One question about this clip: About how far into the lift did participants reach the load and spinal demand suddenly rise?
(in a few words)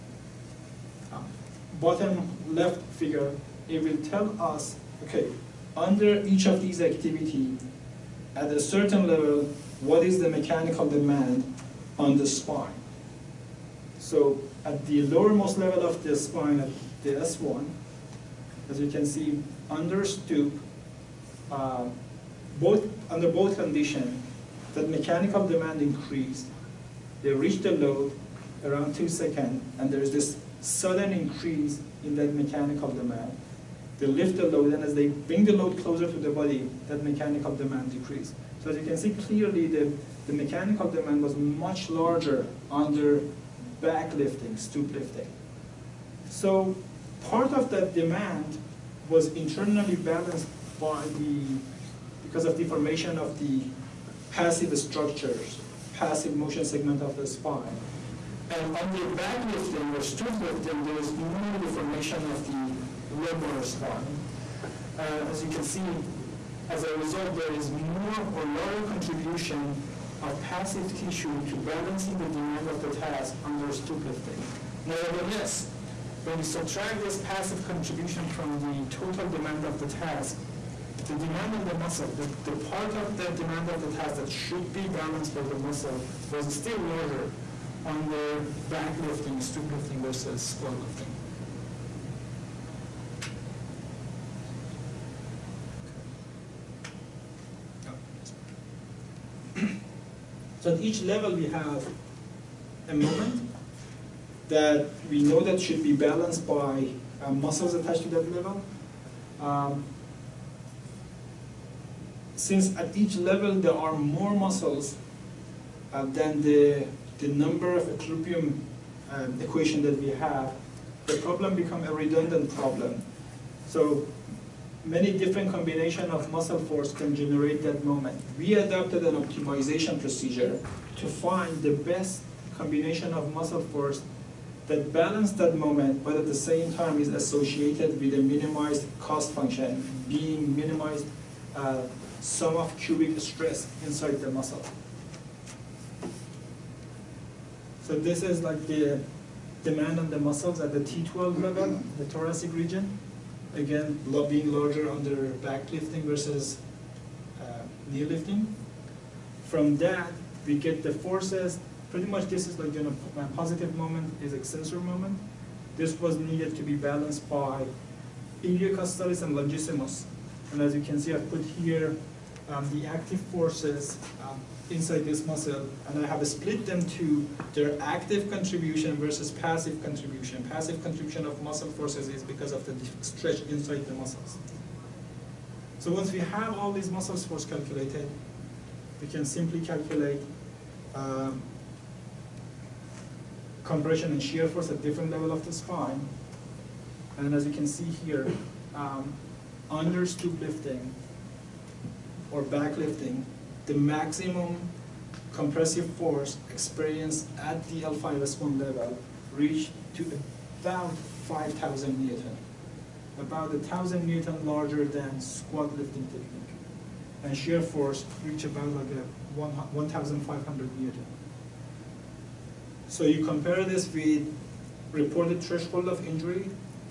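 2 seconds.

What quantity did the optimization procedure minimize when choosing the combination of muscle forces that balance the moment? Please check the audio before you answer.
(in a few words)
sum of cubic stress.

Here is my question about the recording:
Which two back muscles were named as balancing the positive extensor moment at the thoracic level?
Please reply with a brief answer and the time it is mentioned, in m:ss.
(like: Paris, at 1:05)
iliocostalis and longissimus, at 2:48.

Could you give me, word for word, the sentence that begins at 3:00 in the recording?
Passive contribution of muscle forces is because of the stretch inside the muscles.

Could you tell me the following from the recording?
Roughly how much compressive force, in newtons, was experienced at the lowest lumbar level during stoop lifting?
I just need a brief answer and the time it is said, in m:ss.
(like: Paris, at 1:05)
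5,000 Newton, at 3:31.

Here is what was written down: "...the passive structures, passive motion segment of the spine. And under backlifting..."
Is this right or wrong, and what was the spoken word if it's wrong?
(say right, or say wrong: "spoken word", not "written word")
right.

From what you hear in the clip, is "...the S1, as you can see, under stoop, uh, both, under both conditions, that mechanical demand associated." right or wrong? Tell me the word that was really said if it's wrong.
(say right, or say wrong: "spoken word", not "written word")
wrong: "increased", not "associated".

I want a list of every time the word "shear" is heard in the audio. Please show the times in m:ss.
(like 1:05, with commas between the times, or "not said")
3:14, 3:37.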